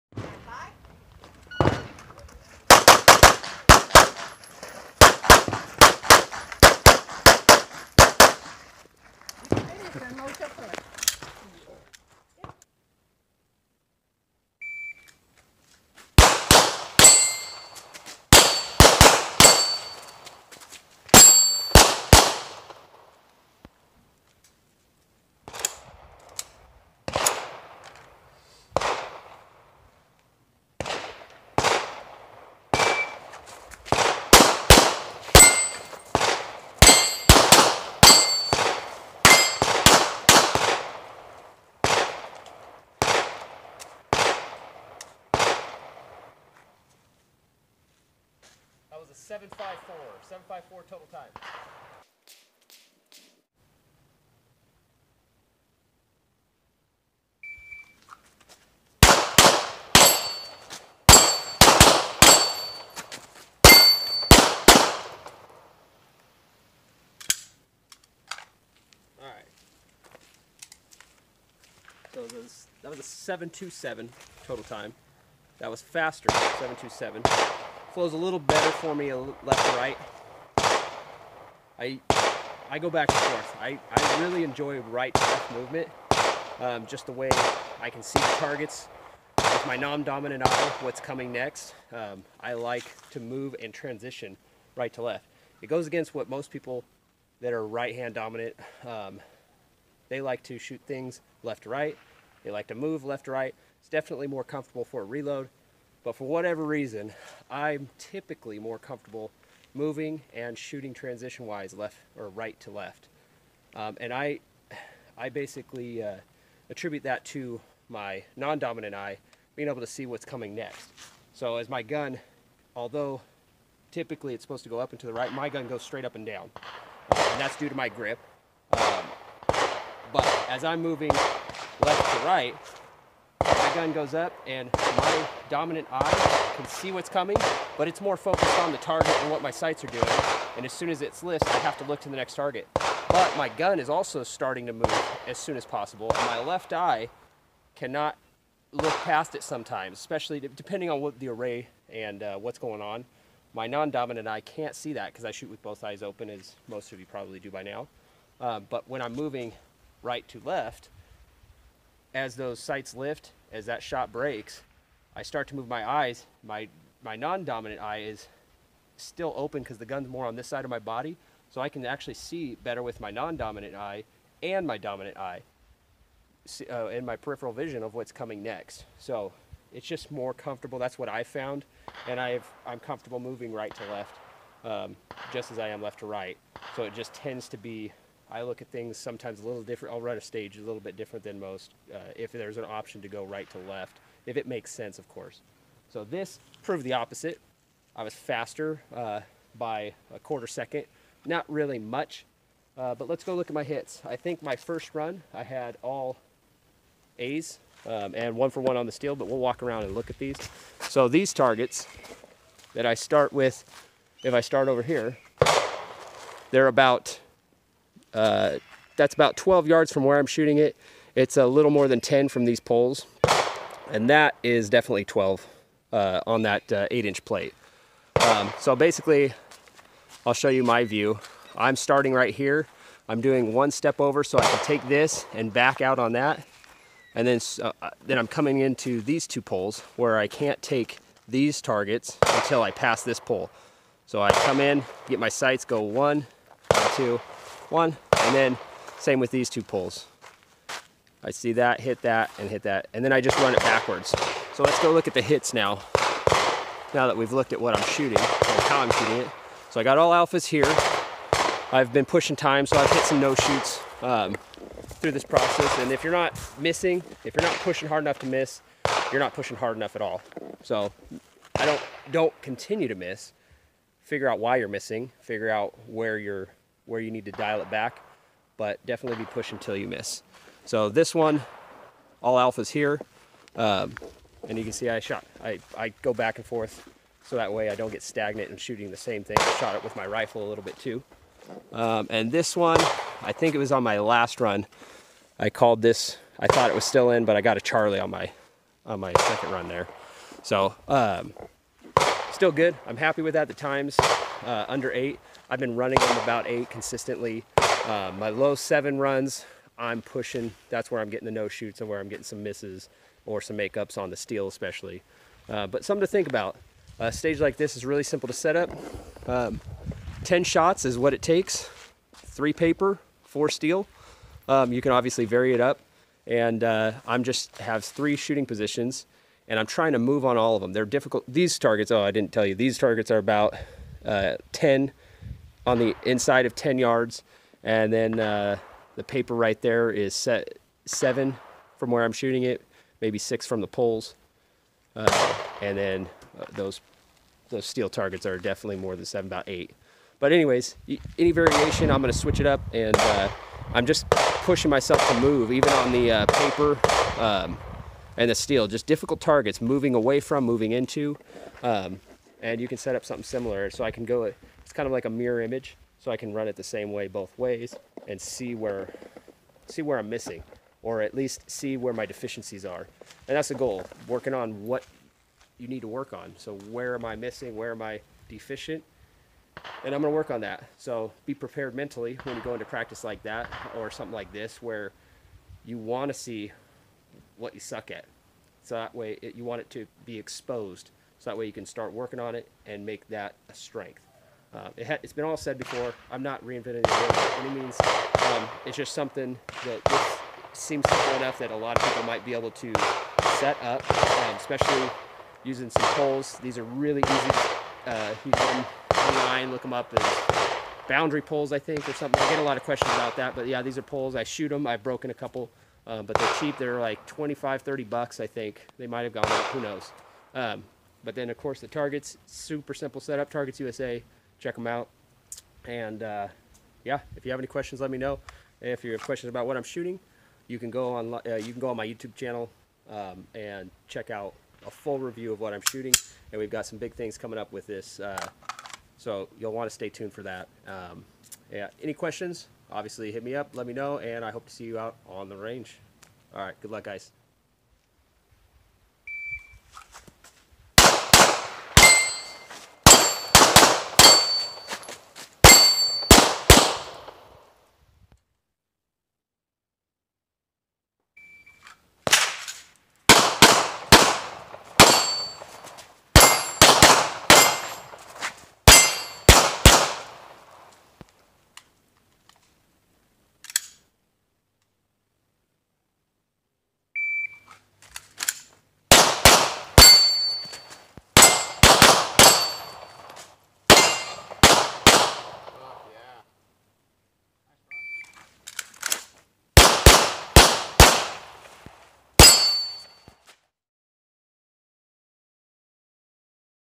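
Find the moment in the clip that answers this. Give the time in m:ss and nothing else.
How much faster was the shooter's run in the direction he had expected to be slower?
3:20.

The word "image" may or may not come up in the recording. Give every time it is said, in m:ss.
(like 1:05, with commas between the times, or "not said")
6:05.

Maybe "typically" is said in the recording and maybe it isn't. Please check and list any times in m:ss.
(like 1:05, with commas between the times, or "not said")
1:47, 2:03.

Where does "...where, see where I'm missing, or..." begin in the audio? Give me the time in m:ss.
6:08.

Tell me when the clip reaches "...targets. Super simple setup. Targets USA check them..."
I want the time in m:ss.
7:01.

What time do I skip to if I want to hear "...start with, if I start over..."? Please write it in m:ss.
3:32.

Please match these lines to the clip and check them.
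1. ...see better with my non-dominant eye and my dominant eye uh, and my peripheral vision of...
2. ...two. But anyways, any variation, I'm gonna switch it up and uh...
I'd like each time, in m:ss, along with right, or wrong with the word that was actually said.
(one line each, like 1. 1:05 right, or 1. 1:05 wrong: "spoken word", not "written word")
1. 2:52 right
2. 5:49 wrong: "eight", not "two".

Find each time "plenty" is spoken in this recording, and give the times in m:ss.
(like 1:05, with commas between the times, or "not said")
not said.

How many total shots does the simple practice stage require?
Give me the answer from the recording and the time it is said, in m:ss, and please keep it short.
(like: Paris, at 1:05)
10, at 5:20.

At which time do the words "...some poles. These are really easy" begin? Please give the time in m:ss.
6:45.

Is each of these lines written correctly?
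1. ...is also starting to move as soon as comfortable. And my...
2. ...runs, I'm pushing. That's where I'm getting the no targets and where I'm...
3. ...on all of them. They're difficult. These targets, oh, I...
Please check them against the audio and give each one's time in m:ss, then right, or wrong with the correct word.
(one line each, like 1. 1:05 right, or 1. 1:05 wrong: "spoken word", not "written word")
1. 2:23 wrong: "possible", not "comfortable"
2. 5:08 wrong: "shoots", not "targets"
3. 5:30 right.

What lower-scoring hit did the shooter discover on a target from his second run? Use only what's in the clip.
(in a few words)
A Charlie.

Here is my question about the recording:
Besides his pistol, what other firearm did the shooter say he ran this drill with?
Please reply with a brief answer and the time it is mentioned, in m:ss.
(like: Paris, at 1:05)
Rifle, at 4:50.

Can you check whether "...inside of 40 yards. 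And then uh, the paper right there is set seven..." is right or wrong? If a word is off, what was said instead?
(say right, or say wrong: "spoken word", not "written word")
wrong: "10", not "40".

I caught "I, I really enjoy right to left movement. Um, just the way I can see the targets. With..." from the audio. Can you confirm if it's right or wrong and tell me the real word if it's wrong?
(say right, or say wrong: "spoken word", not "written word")
right.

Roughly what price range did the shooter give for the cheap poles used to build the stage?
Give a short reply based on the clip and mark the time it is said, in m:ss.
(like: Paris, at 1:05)
25 to 30 dollars, at 6:57.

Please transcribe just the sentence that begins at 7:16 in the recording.
And we've got some big things coming up with this, uh, so you'll want to stay tuned for that.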